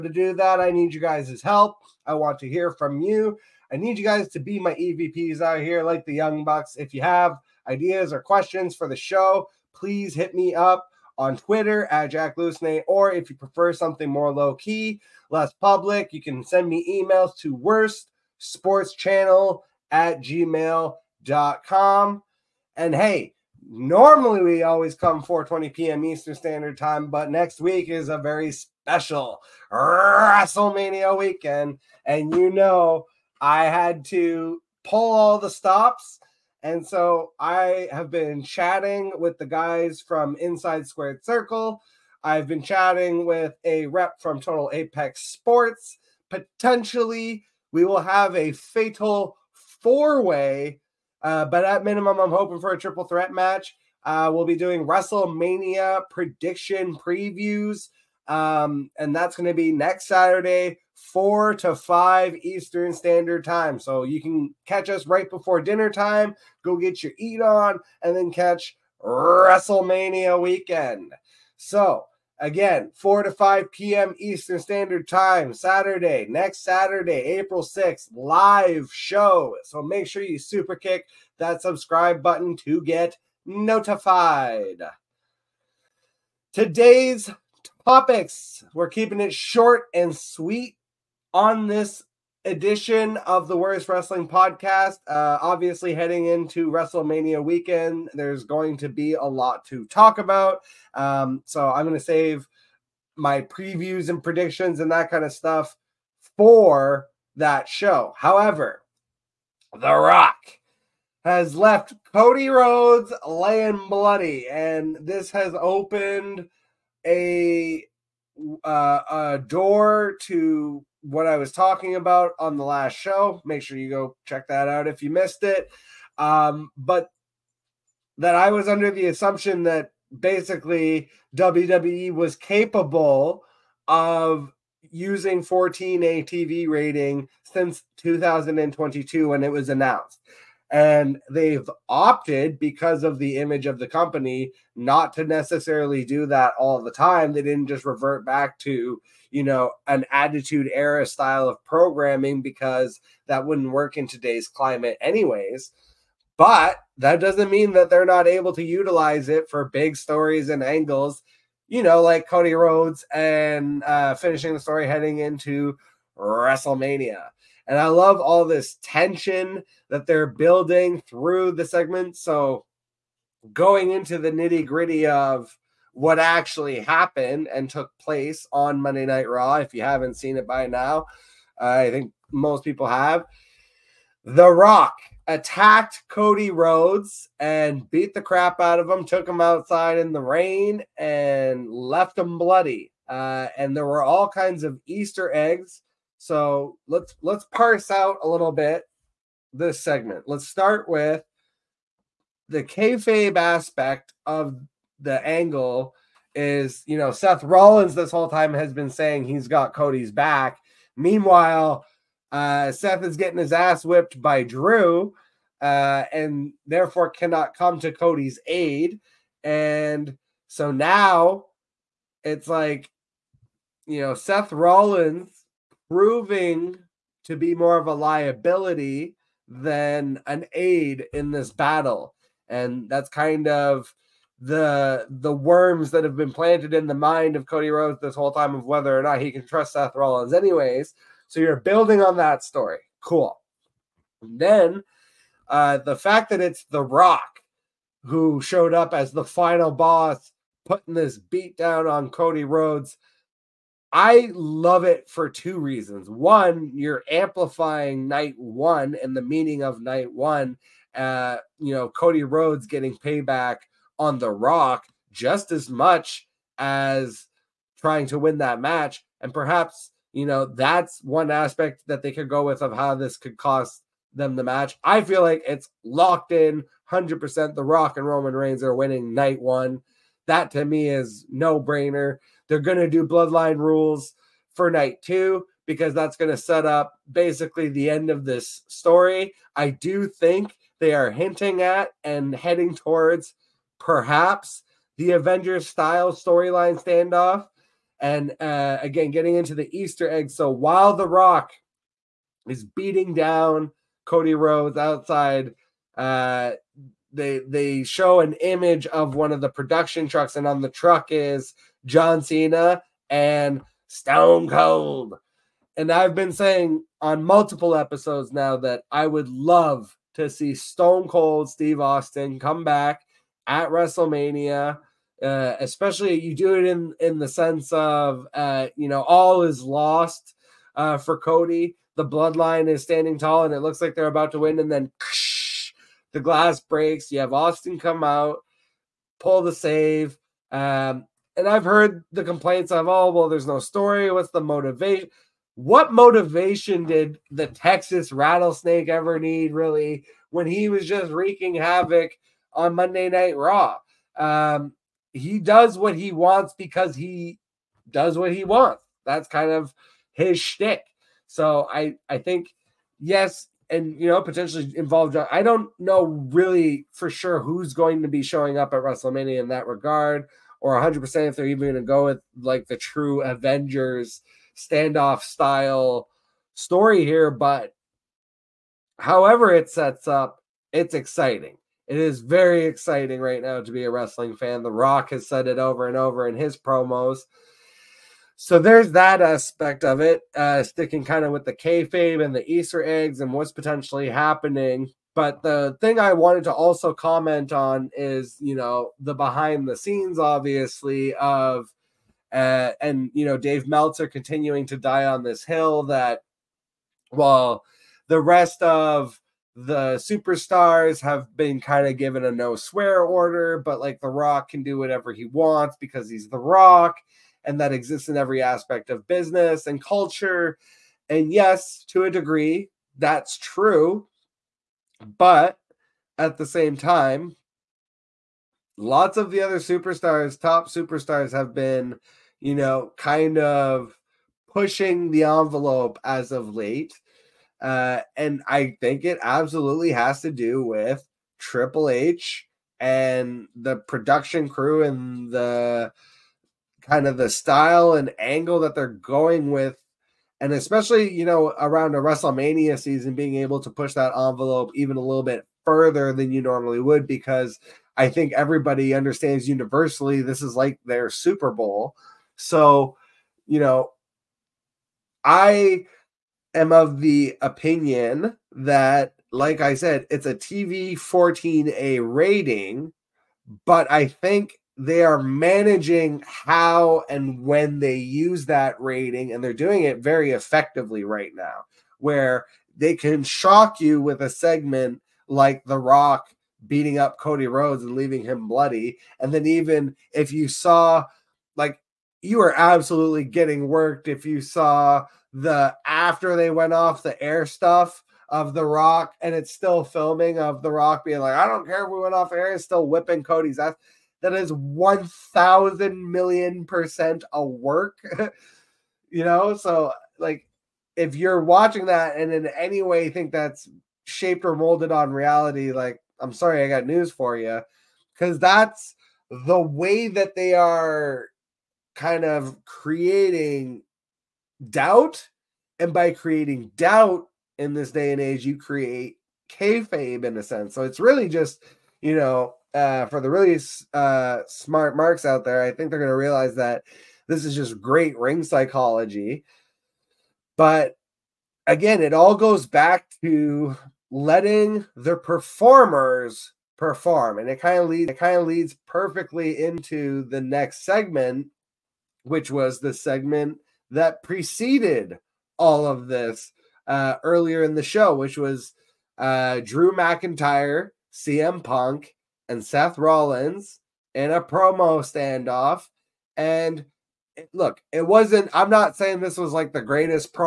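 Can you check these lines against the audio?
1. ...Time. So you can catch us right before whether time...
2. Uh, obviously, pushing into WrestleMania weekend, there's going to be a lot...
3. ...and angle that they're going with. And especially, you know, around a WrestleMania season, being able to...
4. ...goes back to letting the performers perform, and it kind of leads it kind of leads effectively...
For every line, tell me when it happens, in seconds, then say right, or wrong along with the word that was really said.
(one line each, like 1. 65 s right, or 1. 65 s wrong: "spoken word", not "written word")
1. 63 s wrong: "dinner", not "whether"
2. 95 s wrong: "heading", not "pushing"
3. 447 s right
4. 542 s wrong: "perfectly", not "effectively".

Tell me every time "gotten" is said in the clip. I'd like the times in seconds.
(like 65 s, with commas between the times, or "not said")
not said.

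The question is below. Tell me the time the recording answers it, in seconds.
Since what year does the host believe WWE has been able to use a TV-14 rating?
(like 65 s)
137 s.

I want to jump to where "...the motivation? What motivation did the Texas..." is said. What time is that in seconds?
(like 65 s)
344 s.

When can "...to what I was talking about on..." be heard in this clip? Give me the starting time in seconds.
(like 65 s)
120 s.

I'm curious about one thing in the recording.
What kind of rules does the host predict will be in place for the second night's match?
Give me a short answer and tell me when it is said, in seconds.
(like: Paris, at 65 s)
Bloodline rules, at 283 s.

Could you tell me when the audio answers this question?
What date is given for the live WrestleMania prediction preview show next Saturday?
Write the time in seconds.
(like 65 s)
77 s.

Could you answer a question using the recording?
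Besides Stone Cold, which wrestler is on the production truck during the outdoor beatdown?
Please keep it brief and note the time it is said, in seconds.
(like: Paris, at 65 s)
John Cena, at 311 s.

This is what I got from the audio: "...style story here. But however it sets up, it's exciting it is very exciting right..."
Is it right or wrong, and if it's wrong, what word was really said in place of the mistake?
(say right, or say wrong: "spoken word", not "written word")
right.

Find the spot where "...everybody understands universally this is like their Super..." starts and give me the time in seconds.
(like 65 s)
458 s.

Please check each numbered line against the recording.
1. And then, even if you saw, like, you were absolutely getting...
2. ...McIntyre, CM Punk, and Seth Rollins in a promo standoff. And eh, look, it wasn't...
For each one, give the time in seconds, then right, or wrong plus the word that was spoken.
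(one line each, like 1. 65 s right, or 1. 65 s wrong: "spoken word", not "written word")
1. 489 s right
2. 559 s right.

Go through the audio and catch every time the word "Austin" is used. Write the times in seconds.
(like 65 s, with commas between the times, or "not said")
321 s, 337 s.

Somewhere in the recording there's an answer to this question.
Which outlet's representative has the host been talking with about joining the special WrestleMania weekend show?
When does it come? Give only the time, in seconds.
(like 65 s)
44 s.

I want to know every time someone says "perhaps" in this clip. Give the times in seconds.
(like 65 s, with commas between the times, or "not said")
269 s, 293 s.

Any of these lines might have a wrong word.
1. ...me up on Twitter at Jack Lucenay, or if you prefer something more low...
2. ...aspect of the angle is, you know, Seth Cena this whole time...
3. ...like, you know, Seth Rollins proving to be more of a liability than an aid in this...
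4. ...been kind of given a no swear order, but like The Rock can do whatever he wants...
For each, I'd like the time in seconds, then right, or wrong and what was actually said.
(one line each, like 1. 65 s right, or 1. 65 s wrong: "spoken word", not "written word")
1. 10 s right
2. 203 s wrong: "Rollins", not "Cena"
3. 222 s right
4. 411 s right.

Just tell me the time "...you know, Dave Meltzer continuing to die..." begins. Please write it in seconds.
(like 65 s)
403 s.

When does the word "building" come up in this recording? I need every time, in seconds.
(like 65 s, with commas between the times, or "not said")
170 s, 241 s.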